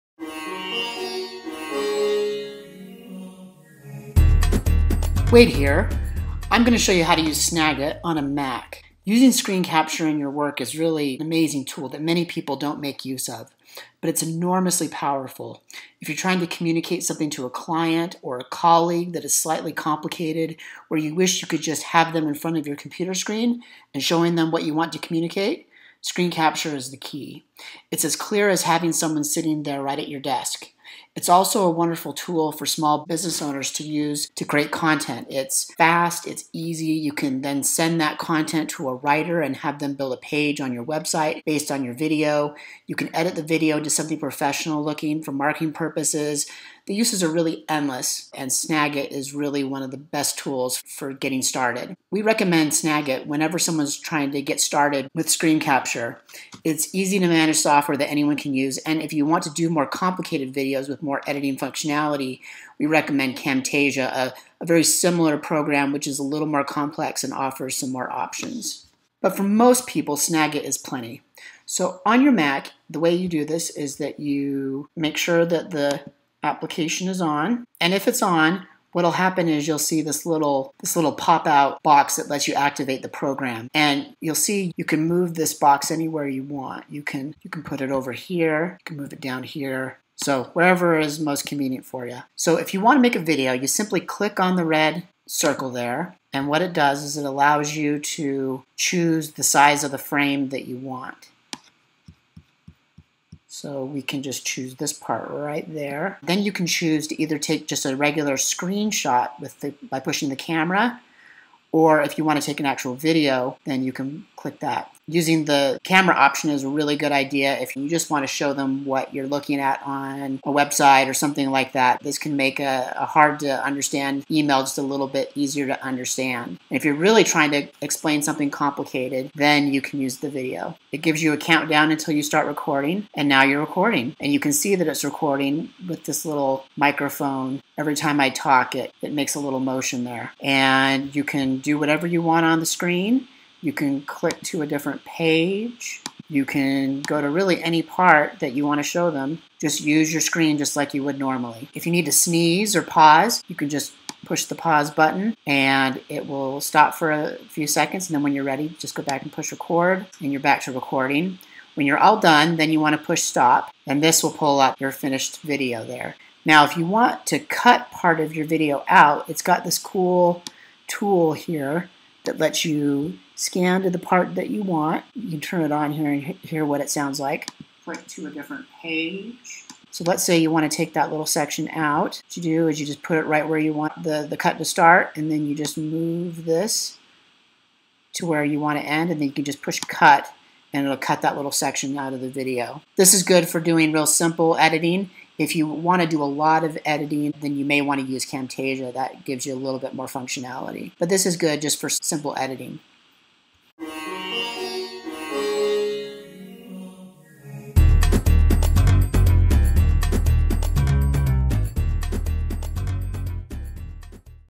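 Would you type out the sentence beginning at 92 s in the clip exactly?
So if you want to make a video, you simply click on the red circle there.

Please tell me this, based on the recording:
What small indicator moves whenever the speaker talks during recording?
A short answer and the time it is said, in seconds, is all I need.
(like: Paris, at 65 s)
microphone, at 136 s.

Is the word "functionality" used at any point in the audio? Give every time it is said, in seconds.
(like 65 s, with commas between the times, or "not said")
61 s, 200 s.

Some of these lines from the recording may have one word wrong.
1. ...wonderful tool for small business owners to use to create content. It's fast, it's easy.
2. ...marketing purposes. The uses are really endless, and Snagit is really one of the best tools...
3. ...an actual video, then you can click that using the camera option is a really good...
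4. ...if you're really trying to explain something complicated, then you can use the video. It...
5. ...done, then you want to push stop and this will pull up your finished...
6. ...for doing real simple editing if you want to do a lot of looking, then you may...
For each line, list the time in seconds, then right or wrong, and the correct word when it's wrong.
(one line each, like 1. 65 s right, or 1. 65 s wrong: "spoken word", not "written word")
1. 31 s right
2. 45 s right
3. 112 s right
4. 126 s right
5. 162 s right
6. 193 s wrong: "editing", not "looking".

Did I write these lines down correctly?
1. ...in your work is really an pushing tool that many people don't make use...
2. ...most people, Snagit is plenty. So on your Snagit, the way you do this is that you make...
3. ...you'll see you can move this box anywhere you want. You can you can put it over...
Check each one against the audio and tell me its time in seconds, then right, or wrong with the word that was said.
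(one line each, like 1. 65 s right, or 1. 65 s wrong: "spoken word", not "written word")
1. 10 s wrong: "amazing", not "pushing"
2. 69 s wrong: "Mac", not "Snagit"
3. 84 s right.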